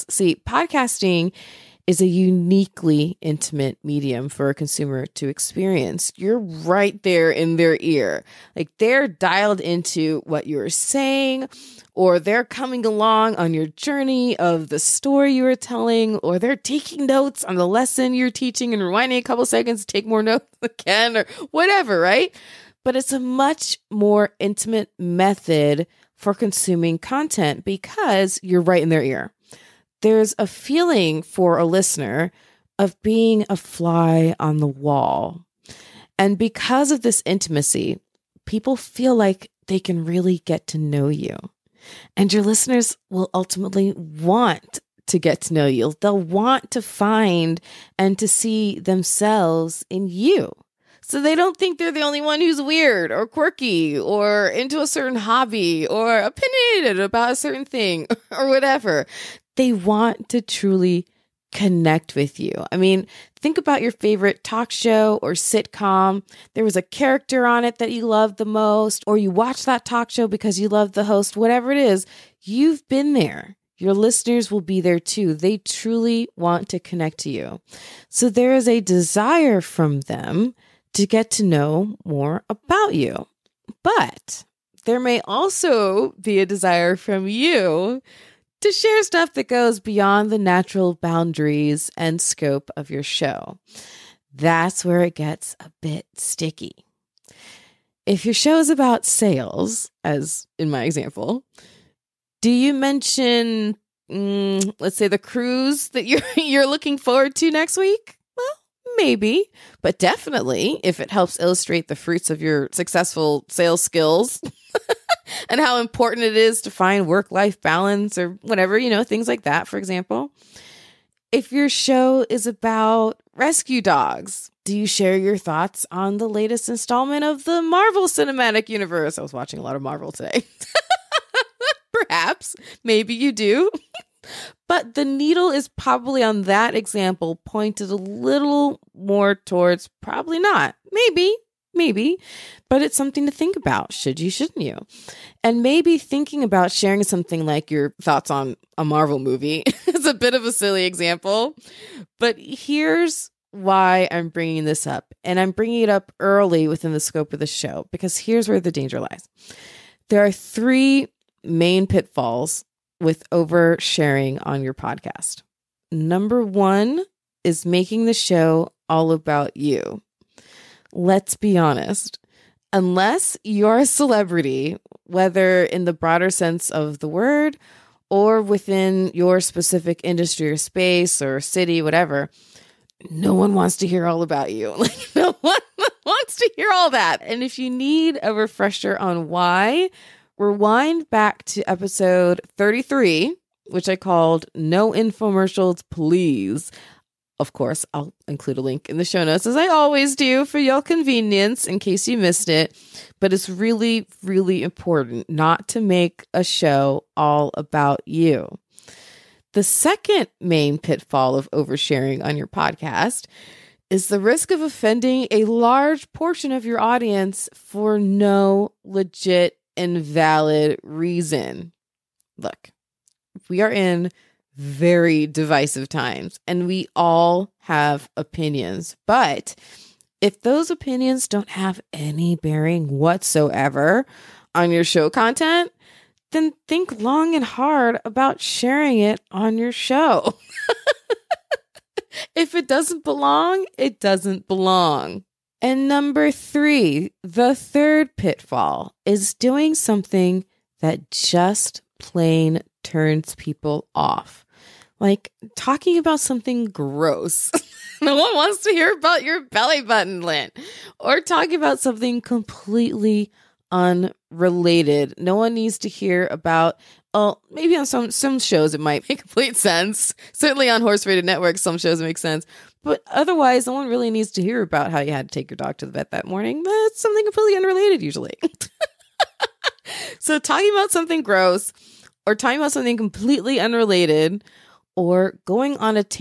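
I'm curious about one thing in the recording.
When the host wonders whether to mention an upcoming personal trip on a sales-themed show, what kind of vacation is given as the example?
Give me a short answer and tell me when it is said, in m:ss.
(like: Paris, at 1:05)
cruise, at 1:45.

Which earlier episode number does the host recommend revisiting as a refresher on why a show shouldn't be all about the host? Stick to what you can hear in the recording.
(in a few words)
33.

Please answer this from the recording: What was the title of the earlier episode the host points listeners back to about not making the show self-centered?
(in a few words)
No Infomercials, Please.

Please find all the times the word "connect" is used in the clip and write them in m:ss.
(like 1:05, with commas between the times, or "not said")
1:01, 1:16.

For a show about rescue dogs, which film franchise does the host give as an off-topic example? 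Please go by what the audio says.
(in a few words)
Marvel Cinematic Universe.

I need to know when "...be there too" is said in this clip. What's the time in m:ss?
1:14.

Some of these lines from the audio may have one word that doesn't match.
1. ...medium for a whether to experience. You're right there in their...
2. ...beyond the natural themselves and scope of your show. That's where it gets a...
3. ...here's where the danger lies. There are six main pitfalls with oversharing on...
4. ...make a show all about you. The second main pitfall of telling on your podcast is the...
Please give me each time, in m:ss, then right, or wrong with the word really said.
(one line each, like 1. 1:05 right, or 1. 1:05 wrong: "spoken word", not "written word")
1. 0:03 wrong: "consumer", not "whether"
2. 1:29 wrong: "boundaries", not "themselves"
3. 2:38 wrong: "three", not "six"
4. 3:25 wrong: "oversharing", not "telling".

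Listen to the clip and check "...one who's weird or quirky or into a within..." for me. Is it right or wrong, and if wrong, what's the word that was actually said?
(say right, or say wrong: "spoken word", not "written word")
wrong: "certain", not "within".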